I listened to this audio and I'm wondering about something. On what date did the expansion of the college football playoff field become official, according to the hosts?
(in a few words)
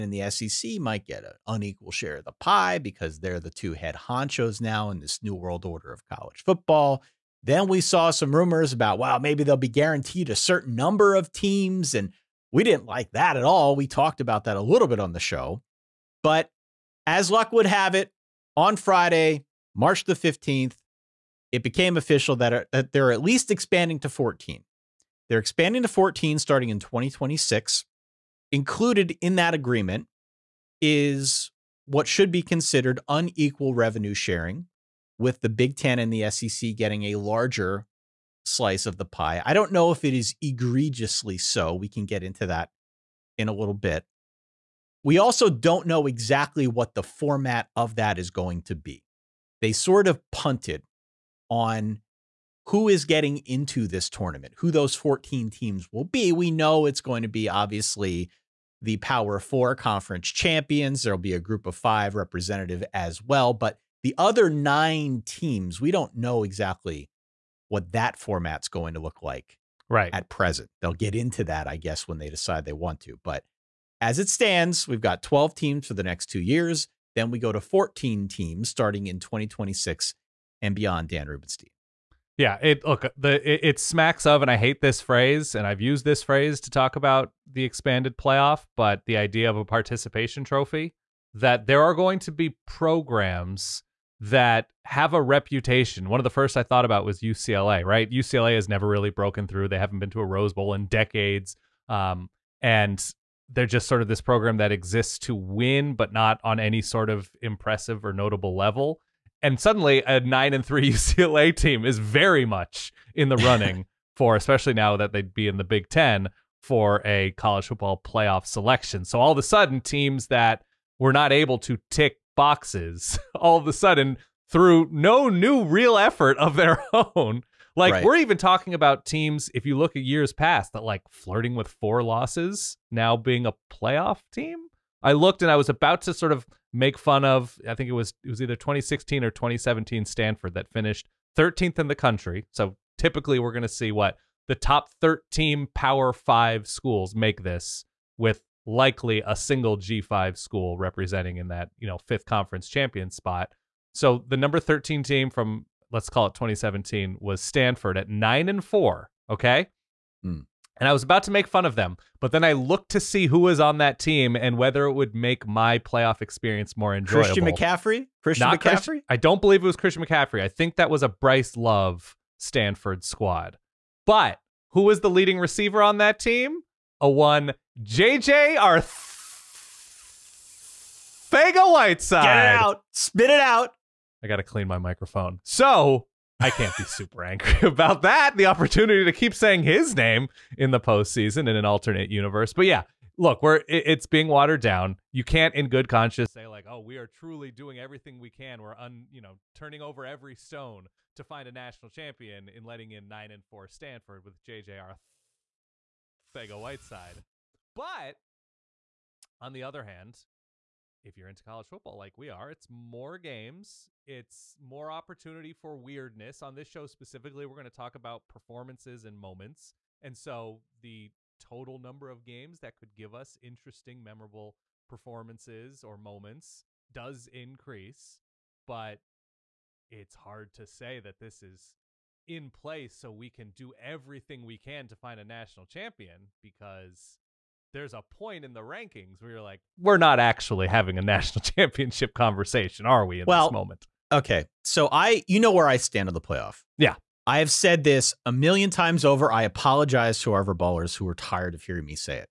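Friday, March 15th.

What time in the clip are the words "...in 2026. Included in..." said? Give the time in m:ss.
0:26.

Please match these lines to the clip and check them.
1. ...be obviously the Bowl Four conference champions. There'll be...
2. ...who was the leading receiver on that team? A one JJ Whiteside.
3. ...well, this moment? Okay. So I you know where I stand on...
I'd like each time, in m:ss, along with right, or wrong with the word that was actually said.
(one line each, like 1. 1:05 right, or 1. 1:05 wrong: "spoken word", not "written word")
1. 0:57 wrong: "Power", not "Bowl"
2. 2:54 wrong: "Arthur", not "Whiteside"
3. 4:03 right.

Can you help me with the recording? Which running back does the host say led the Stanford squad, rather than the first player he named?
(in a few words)
Bryce Love.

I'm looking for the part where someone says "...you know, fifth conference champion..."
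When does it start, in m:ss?
2:31.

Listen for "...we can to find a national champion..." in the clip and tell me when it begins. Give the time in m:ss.
3:54.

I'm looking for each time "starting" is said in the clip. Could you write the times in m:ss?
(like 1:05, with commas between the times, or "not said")
0:26, 1:18.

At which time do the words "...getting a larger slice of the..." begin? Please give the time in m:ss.
0:36.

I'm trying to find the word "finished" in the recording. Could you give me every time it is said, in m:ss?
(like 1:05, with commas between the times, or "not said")
2:20.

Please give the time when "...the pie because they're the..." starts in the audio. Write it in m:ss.
0:02.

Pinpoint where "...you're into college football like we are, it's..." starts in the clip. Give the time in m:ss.
3:31.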